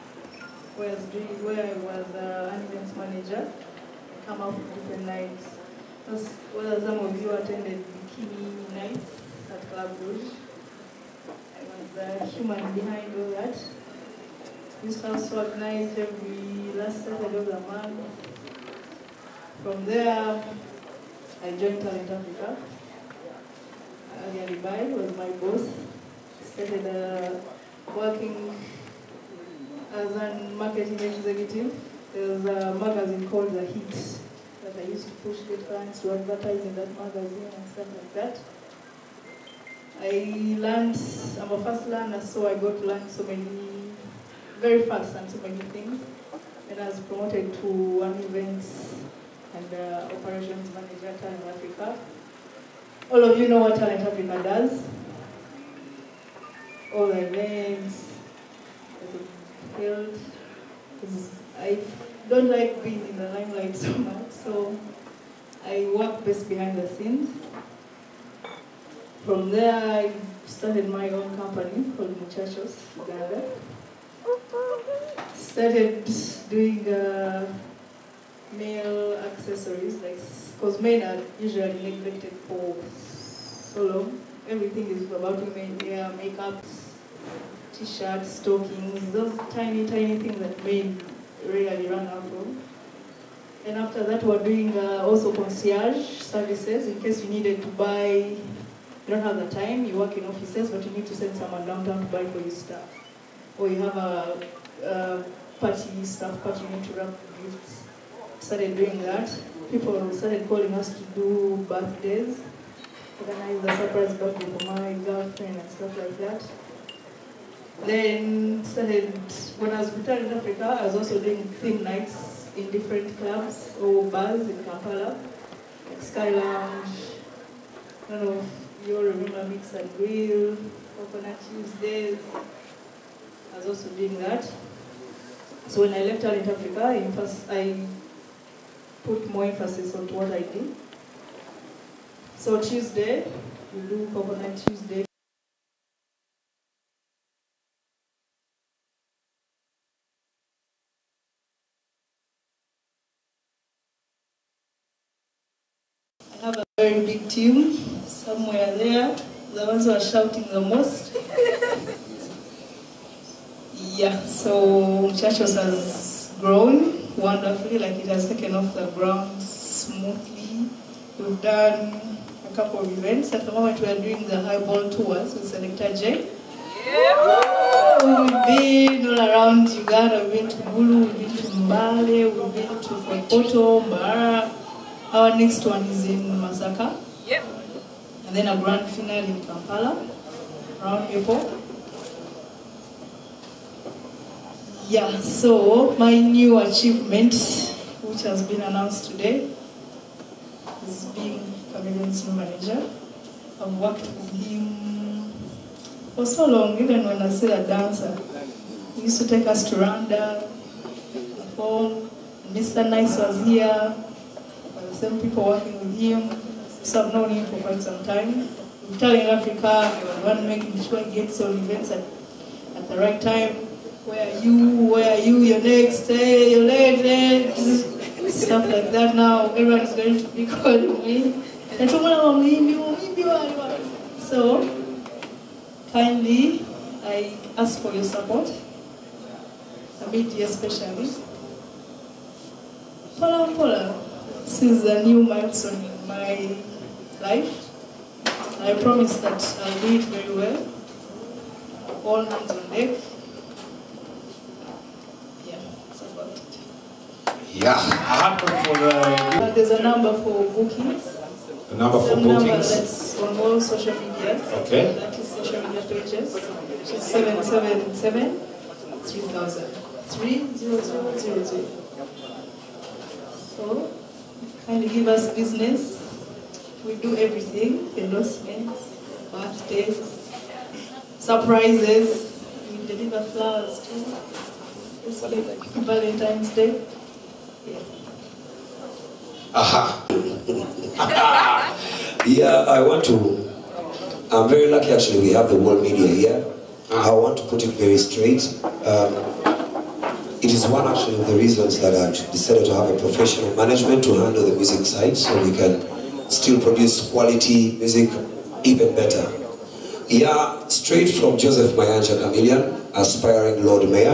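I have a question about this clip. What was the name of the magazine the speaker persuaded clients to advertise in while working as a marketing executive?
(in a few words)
The Heat.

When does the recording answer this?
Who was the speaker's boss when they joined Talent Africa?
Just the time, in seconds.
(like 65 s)
24 s.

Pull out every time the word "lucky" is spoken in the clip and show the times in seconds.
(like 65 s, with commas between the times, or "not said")
294 s.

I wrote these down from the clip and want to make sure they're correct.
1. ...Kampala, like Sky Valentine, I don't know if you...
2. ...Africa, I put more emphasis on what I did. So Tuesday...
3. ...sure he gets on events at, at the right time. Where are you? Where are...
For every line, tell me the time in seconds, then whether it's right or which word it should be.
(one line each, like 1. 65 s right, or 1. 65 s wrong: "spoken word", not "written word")
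1. 124 s wrong: "Lounge", not "Valentine"
2. 136 s right
3. 220 s right.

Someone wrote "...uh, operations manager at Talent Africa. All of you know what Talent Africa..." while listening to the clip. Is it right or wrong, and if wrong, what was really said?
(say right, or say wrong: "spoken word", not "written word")
right.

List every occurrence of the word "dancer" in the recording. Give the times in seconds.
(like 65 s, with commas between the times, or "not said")
207 s.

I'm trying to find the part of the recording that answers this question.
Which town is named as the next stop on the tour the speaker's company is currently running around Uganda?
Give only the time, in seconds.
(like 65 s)
186 s.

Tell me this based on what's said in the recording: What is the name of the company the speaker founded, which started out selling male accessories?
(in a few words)
Muchachos Uganda.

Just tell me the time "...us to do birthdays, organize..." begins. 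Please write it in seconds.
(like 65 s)
110 s.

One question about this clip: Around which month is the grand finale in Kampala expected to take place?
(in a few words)
April.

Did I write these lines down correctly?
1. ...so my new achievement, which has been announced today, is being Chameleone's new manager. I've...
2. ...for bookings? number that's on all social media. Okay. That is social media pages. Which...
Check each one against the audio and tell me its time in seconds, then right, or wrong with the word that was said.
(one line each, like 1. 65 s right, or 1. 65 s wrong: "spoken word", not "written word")
1. 195 s right
2. 262 s right.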